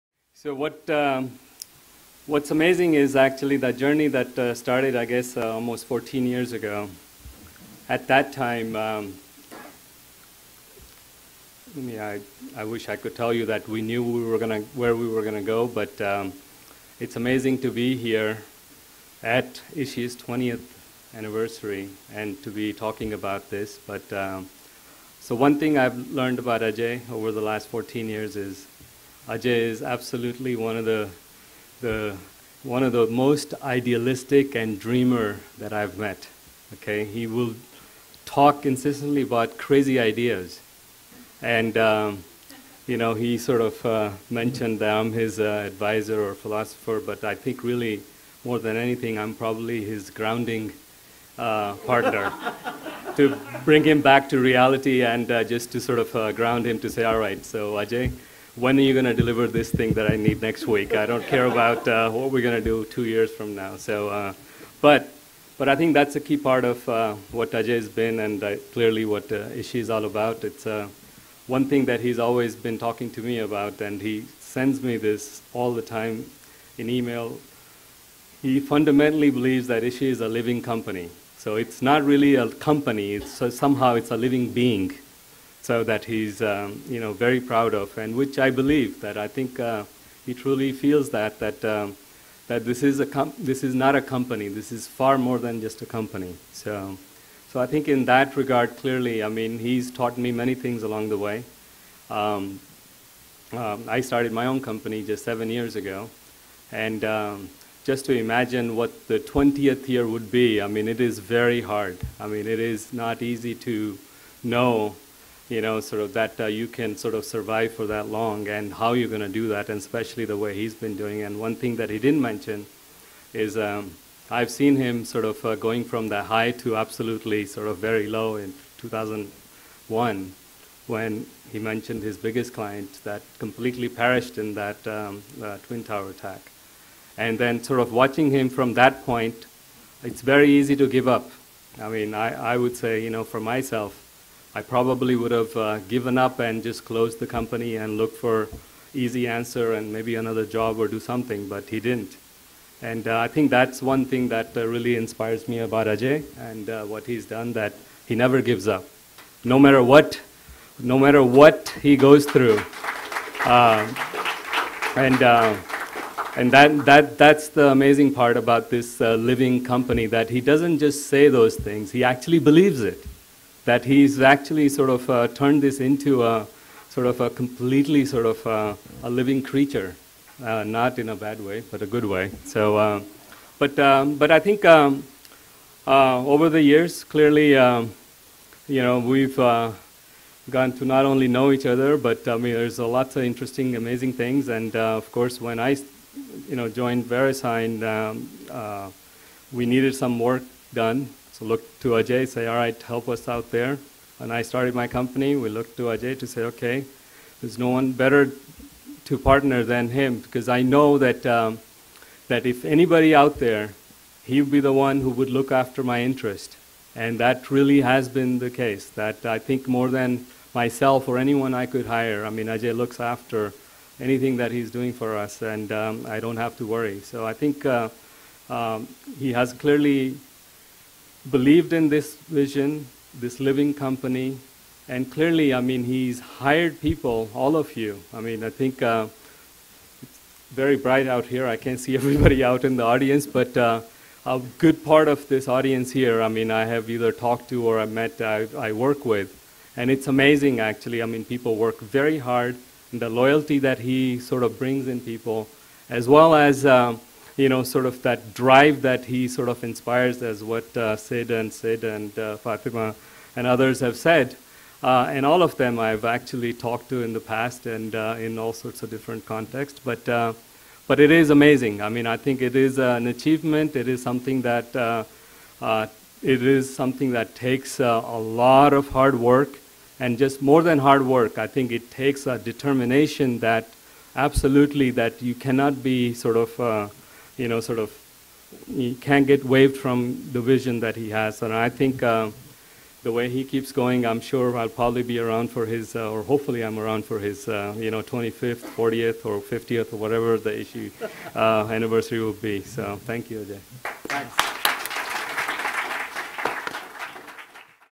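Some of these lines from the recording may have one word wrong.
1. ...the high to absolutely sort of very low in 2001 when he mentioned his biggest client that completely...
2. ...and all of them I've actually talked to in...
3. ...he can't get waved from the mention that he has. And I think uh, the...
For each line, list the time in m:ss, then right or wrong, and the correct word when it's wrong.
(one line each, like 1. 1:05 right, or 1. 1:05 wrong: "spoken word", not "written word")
1. 2:06 right
2. 4:25 right
3. 4:48 wrong: "vision", not "mention".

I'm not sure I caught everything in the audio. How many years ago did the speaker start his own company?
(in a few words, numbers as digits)
7.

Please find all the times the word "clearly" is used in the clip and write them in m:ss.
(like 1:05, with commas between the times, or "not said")
1:08, 1:38, 3:07, 3:49, 3:55.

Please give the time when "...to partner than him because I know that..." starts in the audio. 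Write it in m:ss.
3:29.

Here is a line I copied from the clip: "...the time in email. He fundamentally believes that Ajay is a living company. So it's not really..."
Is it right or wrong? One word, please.
wrong.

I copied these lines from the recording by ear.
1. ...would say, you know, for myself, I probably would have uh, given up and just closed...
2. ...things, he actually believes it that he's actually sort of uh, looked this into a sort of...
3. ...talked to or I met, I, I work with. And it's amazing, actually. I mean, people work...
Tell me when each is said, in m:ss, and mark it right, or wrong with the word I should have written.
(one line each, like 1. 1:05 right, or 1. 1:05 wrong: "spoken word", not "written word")
1. 2:22 right
2. 2:51 wrong: "turned", not "looked"
3. 4:07 right.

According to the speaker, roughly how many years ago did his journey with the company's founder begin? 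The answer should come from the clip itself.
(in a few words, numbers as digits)
14.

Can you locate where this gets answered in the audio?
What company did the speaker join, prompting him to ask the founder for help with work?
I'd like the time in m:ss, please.
3:17.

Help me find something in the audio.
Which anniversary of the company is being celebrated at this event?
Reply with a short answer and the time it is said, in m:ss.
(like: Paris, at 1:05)
20th, at 0:20.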